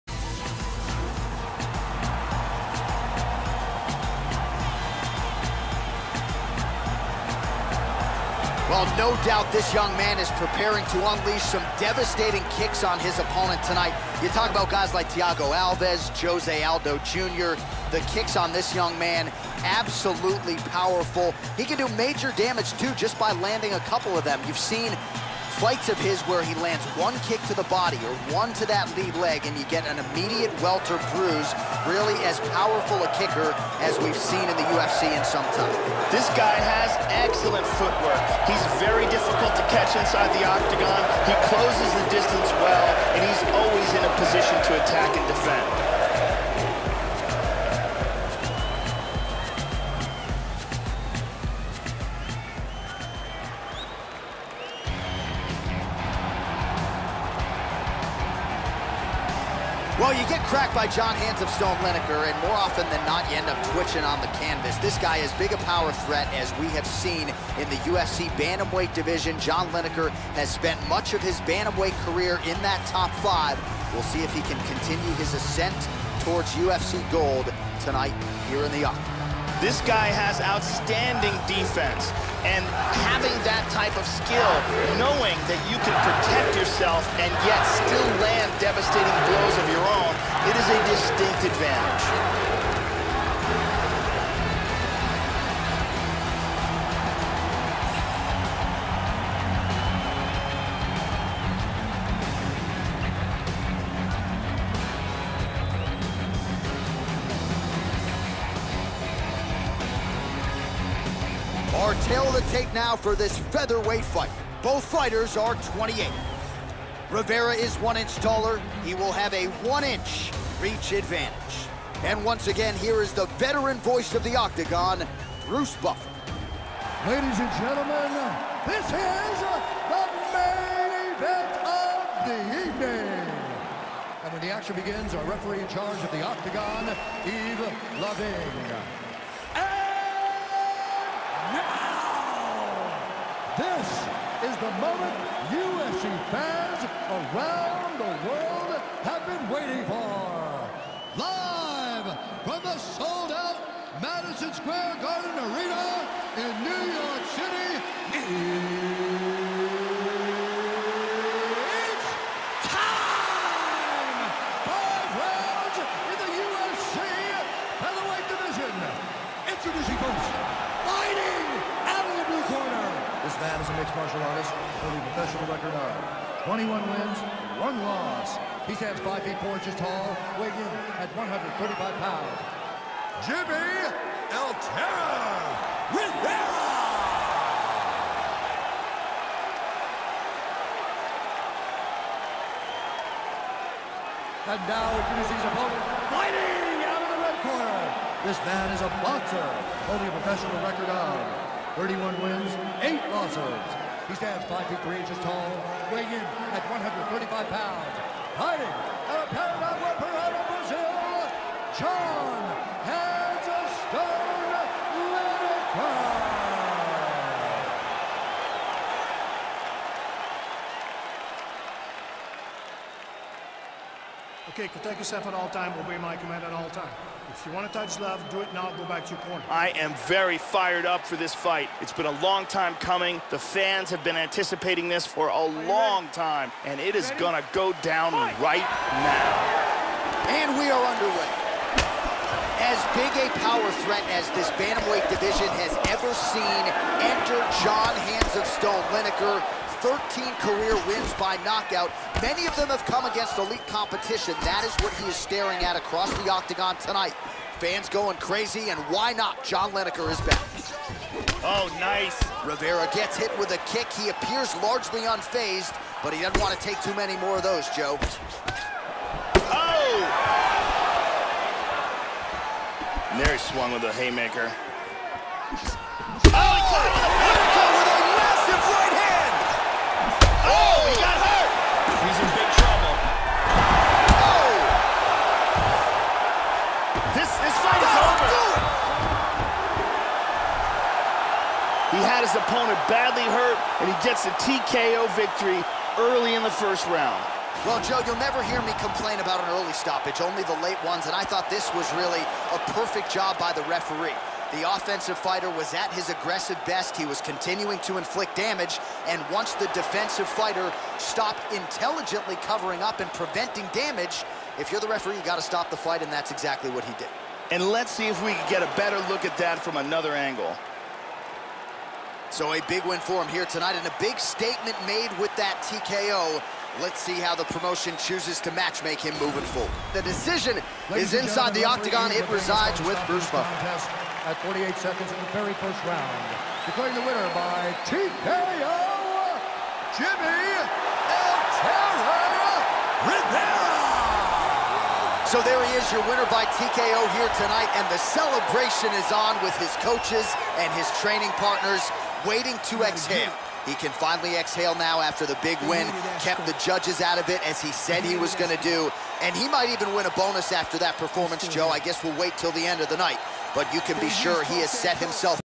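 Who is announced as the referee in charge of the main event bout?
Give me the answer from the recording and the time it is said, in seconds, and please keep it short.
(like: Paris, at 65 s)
Yves Lavigne, at 137 s.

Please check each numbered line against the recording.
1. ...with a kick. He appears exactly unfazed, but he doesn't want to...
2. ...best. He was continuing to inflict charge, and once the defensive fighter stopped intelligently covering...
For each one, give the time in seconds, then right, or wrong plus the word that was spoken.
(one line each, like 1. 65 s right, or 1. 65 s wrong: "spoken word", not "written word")
1. 263 s wrong: "largely", not "exactly"
2. 306 s wrong: "damage", not "charge".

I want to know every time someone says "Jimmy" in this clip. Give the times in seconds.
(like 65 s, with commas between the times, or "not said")
183 s, 339 s.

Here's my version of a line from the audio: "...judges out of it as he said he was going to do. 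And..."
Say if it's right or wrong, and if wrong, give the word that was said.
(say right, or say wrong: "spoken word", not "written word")
right.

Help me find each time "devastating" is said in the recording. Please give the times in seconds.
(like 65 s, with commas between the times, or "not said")
11 s, 88 s.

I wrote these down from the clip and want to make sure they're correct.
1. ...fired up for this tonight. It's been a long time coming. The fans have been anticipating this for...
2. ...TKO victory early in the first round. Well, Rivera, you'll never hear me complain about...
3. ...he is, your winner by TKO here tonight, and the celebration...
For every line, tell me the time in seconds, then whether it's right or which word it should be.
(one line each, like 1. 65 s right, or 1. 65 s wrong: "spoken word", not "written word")
1. 230 s wrong: "fight", not "tonight"
2. 294 s wrong: "Joe", not "Rivera"
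3. 345 s right.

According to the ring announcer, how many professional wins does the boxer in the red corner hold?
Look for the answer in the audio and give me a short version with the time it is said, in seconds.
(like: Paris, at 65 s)
31, at 201 s.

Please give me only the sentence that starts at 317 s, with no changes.
And let's see if we can get a better look at that from another angle.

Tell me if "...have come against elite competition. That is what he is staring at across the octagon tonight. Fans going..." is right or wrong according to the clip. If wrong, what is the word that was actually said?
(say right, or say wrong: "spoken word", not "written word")
right.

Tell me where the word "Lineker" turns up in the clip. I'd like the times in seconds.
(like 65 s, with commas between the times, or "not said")
61 s, 69 s, 248 s, 259 s.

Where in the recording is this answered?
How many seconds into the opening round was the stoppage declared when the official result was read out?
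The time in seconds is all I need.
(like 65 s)
334 s.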